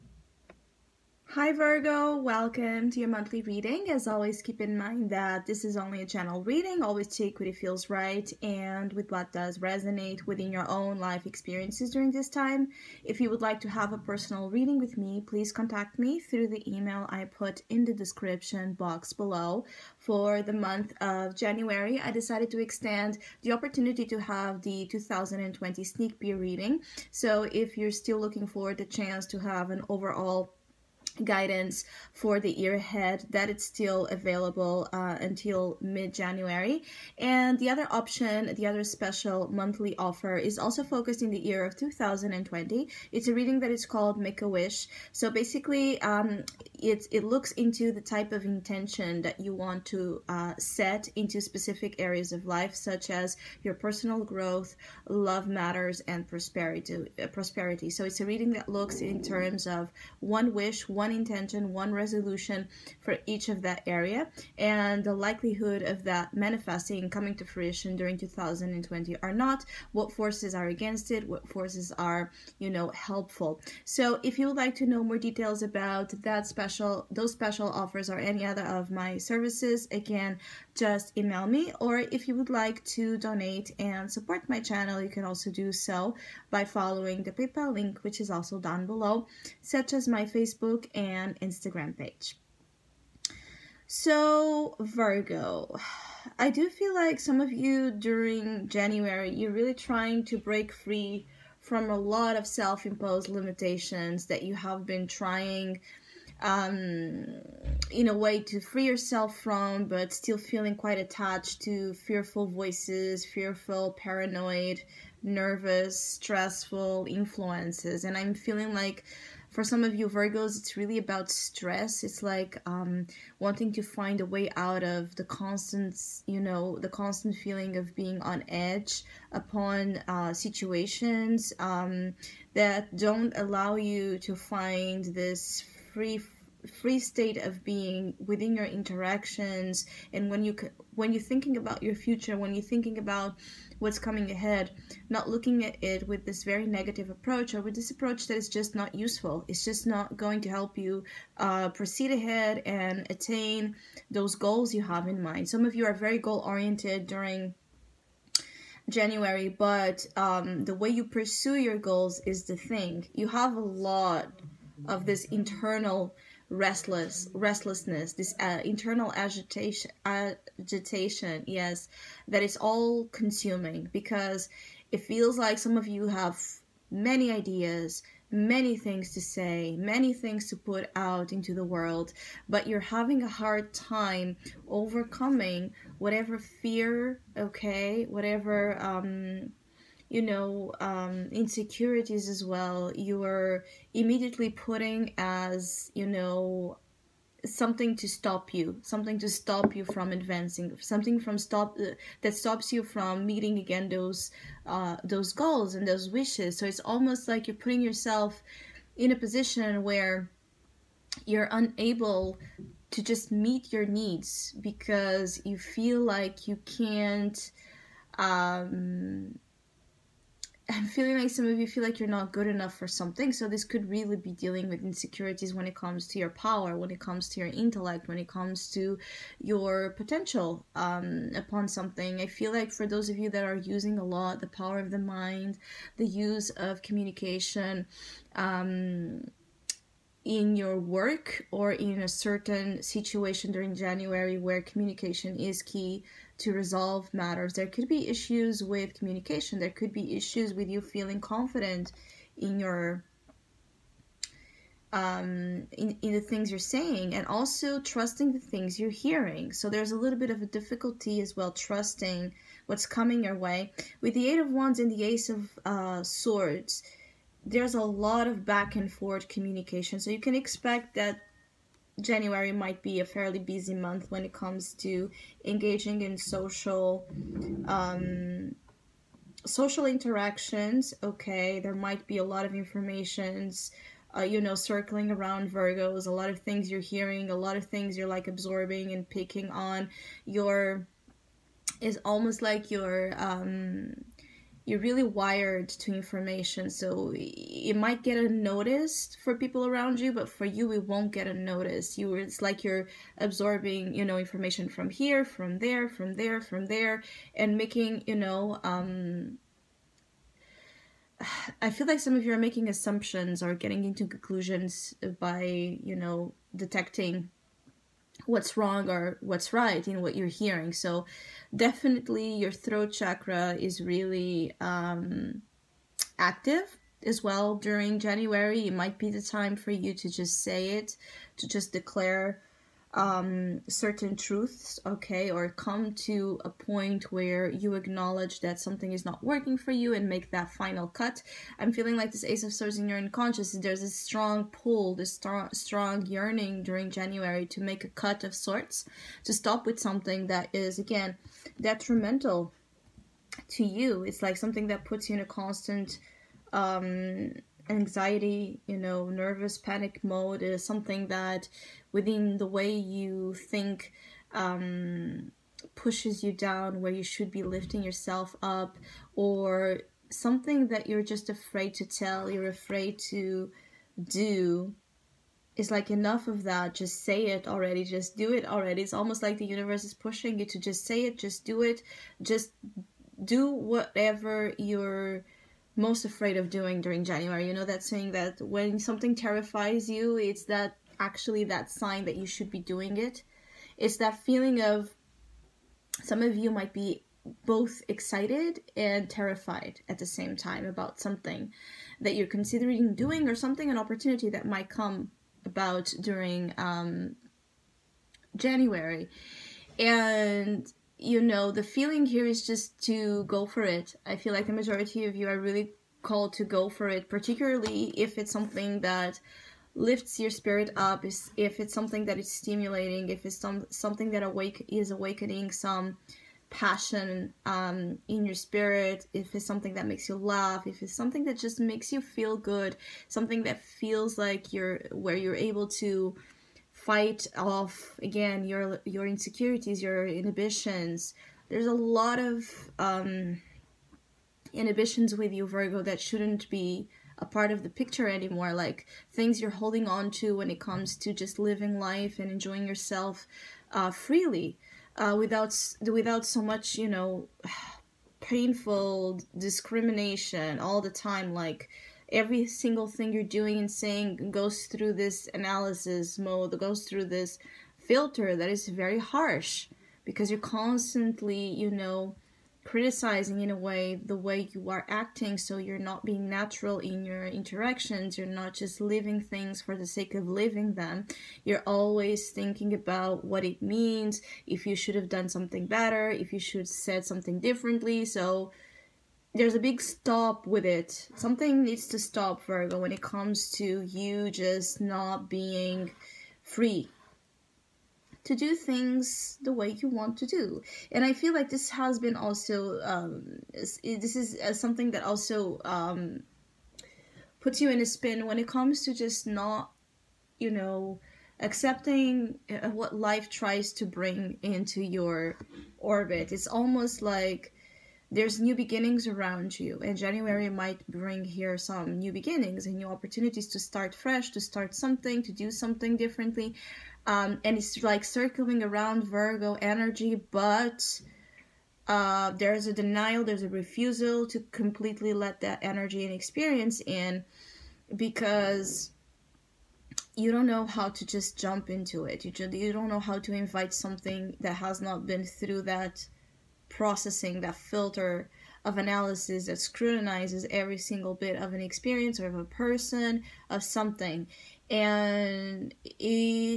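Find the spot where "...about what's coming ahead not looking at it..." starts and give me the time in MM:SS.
02:22.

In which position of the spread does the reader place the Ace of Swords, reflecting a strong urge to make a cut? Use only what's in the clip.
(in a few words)
Unconscious.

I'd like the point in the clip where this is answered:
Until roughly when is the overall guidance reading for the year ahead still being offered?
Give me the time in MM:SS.
00:35.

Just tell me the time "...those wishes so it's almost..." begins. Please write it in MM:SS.
03:25.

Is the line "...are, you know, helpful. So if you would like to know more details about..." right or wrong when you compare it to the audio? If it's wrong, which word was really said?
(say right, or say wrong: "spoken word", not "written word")
right.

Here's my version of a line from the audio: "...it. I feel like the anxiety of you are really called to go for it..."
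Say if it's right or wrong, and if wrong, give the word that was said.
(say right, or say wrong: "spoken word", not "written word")
wrong: "majority", not "anxiety".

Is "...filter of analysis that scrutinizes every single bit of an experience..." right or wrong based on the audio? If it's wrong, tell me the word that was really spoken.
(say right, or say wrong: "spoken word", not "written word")
right.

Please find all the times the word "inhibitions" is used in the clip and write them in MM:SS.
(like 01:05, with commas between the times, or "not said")
07:20, 07:24.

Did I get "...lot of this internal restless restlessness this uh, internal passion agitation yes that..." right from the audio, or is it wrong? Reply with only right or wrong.
wrong.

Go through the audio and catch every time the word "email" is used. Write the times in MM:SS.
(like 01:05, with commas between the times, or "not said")
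00:16, 01:21.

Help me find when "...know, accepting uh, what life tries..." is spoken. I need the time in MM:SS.
08:30.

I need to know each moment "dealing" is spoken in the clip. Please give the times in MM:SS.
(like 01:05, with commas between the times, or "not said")
03:44.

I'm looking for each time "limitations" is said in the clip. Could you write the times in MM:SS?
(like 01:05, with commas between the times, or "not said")
01:43.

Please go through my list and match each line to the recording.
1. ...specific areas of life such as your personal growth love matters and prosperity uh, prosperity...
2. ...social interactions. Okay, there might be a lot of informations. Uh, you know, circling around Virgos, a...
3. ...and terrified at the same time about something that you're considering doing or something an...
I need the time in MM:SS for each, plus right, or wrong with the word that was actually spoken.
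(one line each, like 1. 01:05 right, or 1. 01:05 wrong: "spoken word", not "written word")
1. 00:51 right
2. 04:39 right
3. 06:38 right.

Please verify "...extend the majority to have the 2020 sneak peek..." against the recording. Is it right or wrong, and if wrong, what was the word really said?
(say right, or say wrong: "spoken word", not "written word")
wrong: "opportunity", not "majority".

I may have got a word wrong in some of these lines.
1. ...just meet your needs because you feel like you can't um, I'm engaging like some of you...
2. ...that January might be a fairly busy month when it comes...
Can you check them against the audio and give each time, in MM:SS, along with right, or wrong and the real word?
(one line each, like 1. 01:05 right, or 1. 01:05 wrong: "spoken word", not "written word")
1. 03:33 wrong: "feeling", not "engaging"
2. 04:30 right.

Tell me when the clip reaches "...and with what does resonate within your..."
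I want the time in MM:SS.
00:08.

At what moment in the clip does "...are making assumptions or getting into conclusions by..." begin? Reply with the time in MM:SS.
05:12.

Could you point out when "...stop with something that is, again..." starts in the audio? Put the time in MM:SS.
05:49.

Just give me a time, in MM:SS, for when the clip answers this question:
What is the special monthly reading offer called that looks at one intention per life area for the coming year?
00:44.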